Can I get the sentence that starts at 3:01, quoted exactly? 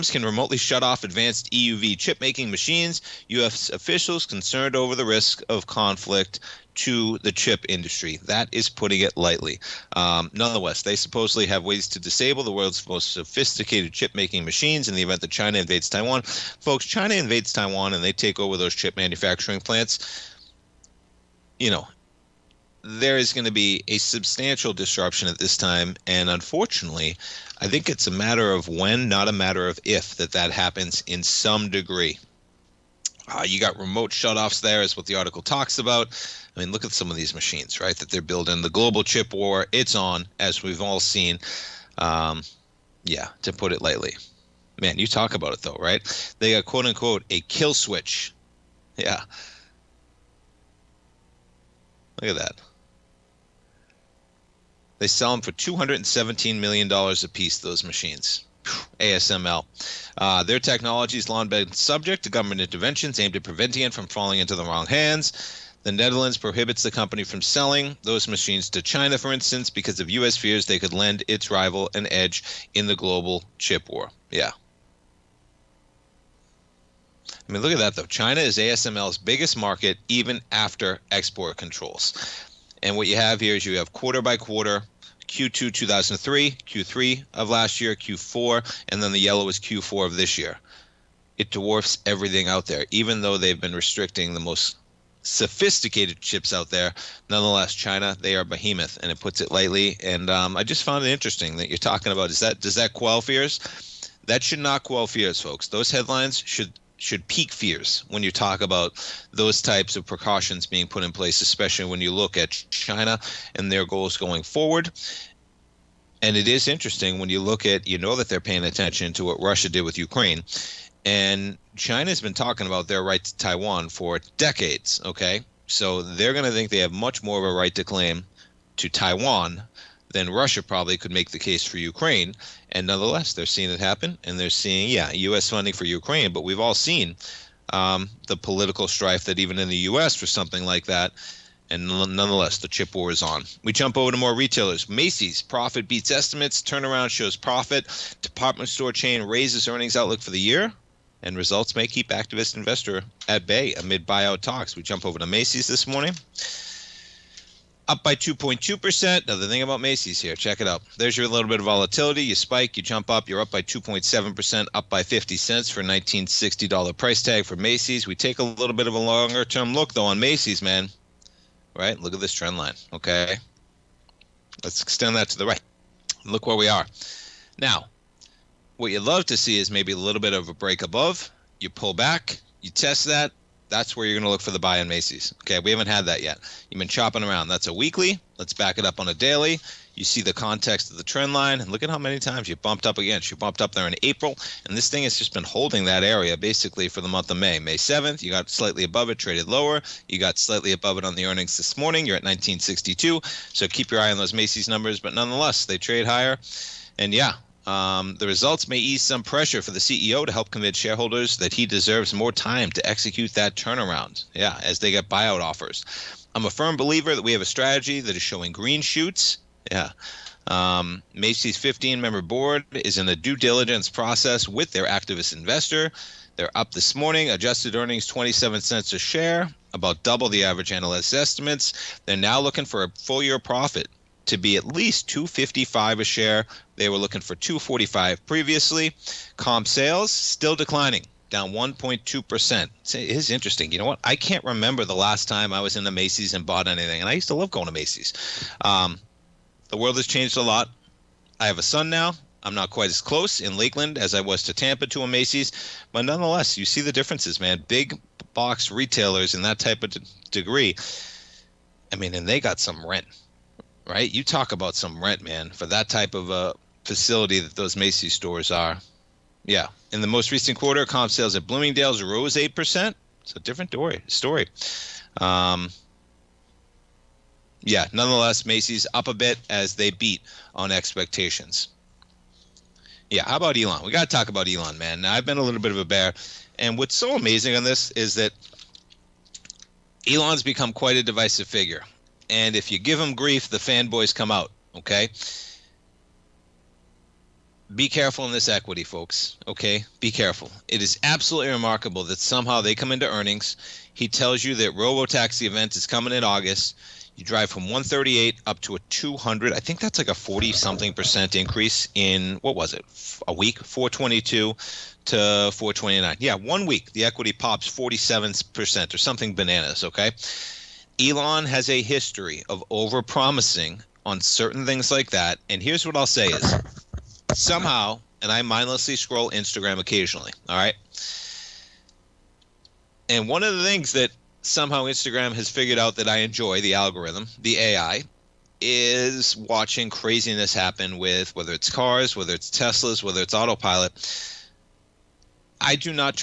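You pull back, you test that, that's where you're going to look for the buy in Macy's.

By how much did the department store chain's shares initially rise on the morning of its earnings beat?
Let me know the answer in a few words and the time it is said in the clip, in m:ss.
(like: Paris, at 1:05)
2.2%, at 2:38.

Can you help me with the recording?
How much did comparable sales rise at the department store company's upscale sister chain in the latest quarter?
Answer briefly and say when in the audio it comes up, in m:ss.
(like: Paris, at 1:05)
8%, at 4:32.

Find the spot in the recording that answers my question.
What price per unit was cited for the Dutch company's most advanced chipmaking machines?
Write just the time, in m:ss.
0:55.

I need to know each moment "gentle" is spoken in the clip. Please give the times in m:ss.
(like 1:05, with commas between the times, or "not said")
not said.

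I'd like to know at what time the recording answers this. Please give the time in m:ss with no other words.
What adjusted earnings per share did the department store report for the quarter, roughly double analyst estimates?
3:48.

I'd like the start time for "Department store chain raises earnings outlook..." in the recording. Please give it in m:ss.
2:28.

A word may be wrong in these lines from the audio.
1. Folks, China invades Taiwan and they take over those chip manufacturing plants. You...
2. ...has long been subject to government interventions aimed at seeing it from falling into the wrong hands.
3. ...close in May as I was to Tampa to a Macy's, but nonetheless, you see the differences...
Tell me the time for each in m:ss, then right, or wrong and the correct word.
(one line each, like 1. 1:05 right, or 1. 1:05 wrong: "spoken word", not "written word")
1. 0:16 right
2. 1:01 wrong: "preventing", not "seeing"
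3. 4:13 wrong: "Lakeland", not "May".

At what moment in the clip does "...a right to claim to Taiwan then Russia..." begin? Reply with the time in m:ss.
2:07.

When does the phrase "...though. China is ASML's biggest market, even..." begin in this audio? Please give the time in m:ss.
1:17.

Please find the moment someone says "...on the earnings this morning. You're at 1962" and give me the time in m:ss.
3:21.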